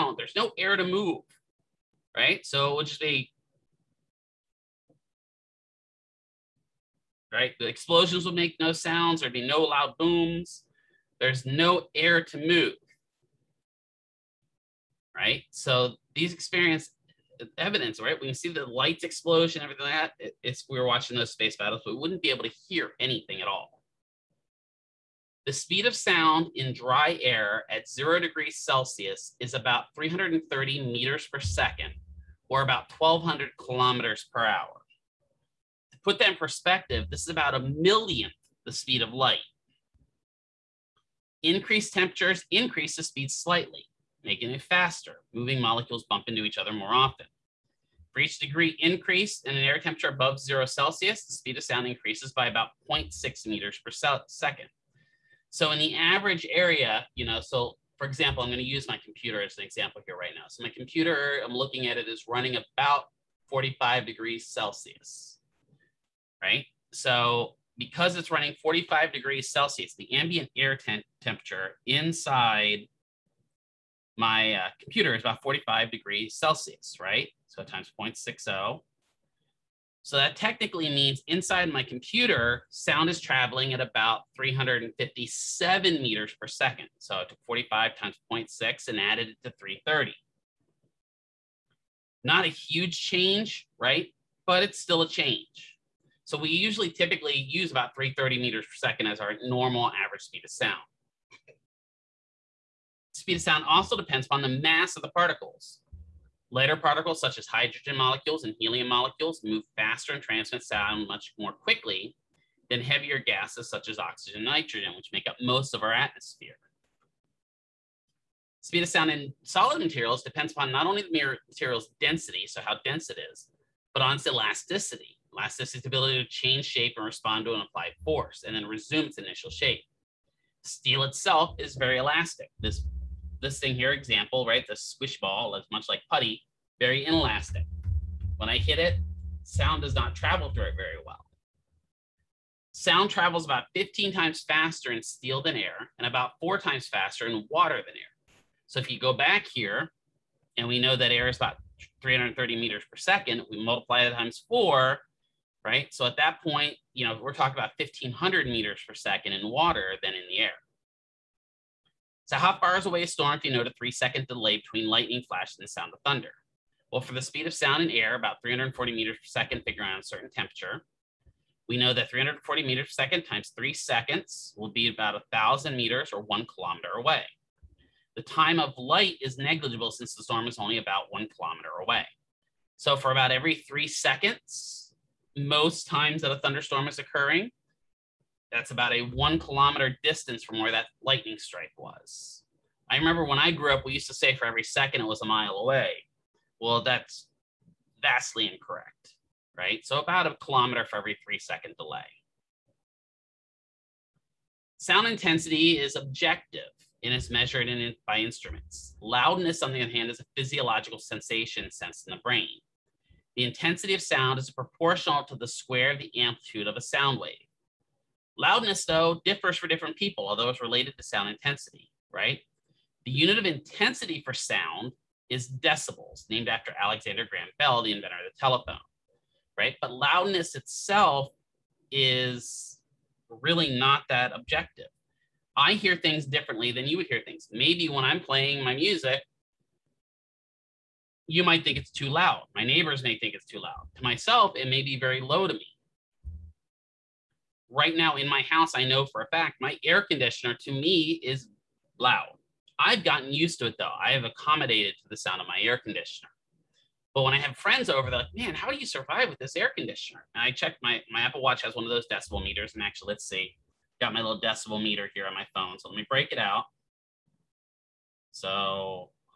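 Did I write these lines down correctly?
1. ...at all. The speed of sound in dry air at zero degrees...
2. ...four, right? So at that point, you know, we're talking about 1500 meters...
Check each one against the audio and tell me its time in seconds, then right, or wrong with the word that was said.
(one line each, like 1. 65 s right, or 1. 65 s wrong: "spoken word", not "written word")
1. 23 s right
2. 154 s right.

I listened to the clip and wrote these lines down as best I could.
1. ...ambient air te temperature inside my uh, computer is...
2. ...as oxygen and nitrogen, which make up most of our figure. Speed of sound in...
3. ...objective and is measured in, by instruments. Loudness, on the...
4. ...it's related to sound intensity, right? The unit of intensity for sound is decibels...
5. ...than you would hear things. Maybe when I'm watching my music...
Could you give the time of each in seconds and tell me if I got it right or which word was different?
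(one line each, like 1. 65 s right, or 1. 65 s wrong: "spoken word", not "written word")
1. 70 s right
2. 113 s wrong: "atmosphere", not "figure"
3. 205 s right
4. 220 s right
5. 236 s wrong: "playing", not "watching".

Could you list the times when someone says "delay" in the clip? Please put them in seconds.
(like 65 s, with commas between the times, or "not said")
164 s, 201 s.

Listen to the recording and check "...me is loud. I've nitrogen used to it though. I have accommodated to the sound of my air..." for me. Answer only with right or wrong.
wrong.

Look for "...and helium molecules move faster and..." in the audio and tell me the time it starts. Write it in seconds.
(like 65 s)
108 s.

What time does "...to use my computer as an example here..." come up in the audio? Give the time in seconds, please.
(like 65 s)
58 s.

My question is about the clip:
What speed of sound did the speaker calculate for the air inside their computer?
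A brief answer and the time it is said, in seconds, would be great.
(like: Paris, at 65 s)
357 meters per second, at 84 s.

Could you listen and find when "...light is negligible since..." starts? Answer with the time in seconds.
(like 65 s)
178 s.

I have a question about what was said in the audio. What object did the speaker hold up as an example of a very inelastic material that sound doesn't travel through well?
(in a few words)
squish ball.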